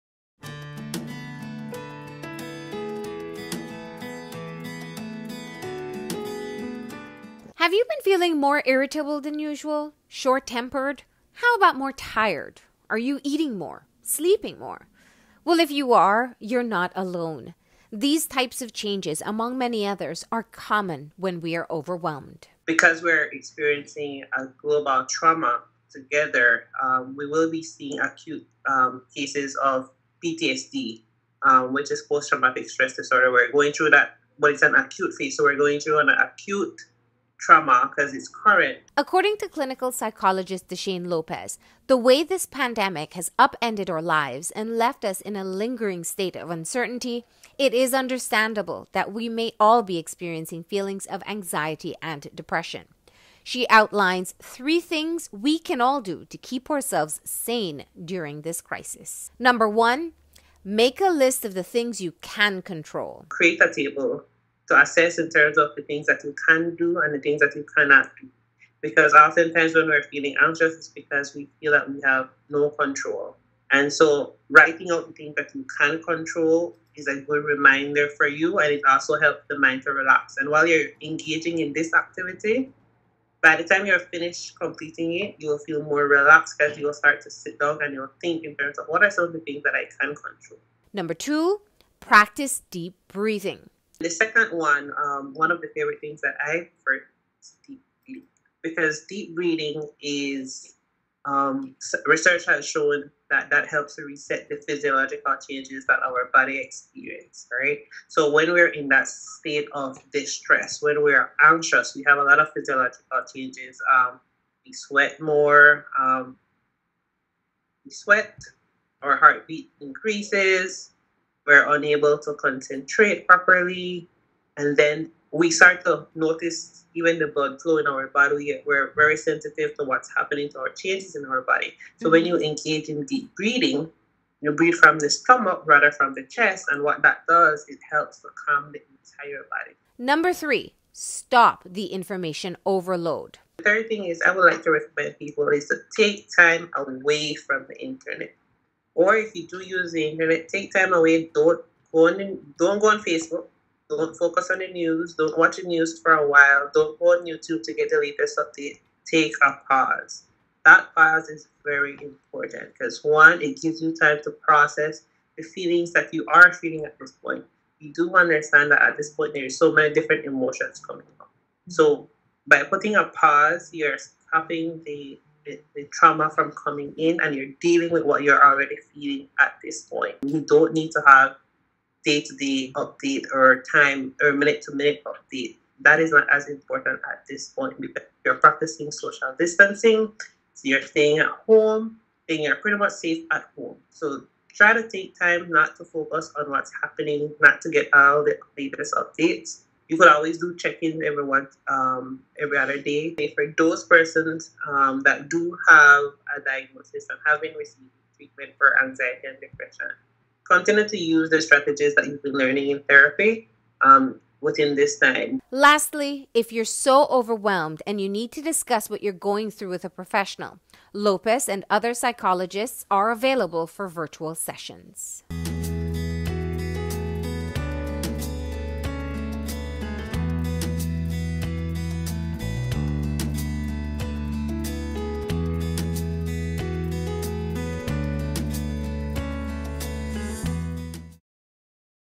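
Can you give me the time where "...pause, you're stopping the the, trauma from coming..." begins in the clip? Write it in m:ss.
2:53.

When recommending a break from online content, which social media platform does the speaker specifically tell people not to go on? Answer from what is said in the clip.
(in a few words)
Facebook.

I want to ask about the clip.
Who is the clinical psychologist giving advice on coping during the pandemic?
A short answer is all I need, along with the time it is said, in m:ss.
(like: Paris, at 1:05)
Deshane Lopez, at 0:40.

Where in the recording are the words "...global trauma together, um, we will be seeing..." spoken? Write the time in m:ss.
0:24.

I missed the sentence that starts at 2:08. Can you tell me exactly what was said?
We're very sensitive to what's happening to our changes in our body.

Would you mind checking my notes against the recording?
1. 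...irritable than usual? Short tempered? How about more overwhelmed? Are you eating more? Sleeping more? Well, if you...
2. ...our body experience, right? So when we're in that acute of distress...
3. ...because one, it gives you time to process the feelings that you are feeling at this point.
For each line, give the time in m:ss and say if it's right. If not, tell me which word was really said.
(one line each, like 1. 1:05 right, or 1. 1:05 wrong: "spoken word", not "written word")
1. 0:08 wrong: "tired", not "overwhelmed"
2. 1:46 wrong: "state", not "acute"
3. 2:42 right.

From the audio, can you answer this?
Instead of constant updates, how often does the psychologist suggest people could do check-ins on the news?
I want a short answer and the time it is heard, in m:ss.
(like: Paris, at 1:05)
every other day, at 3:22.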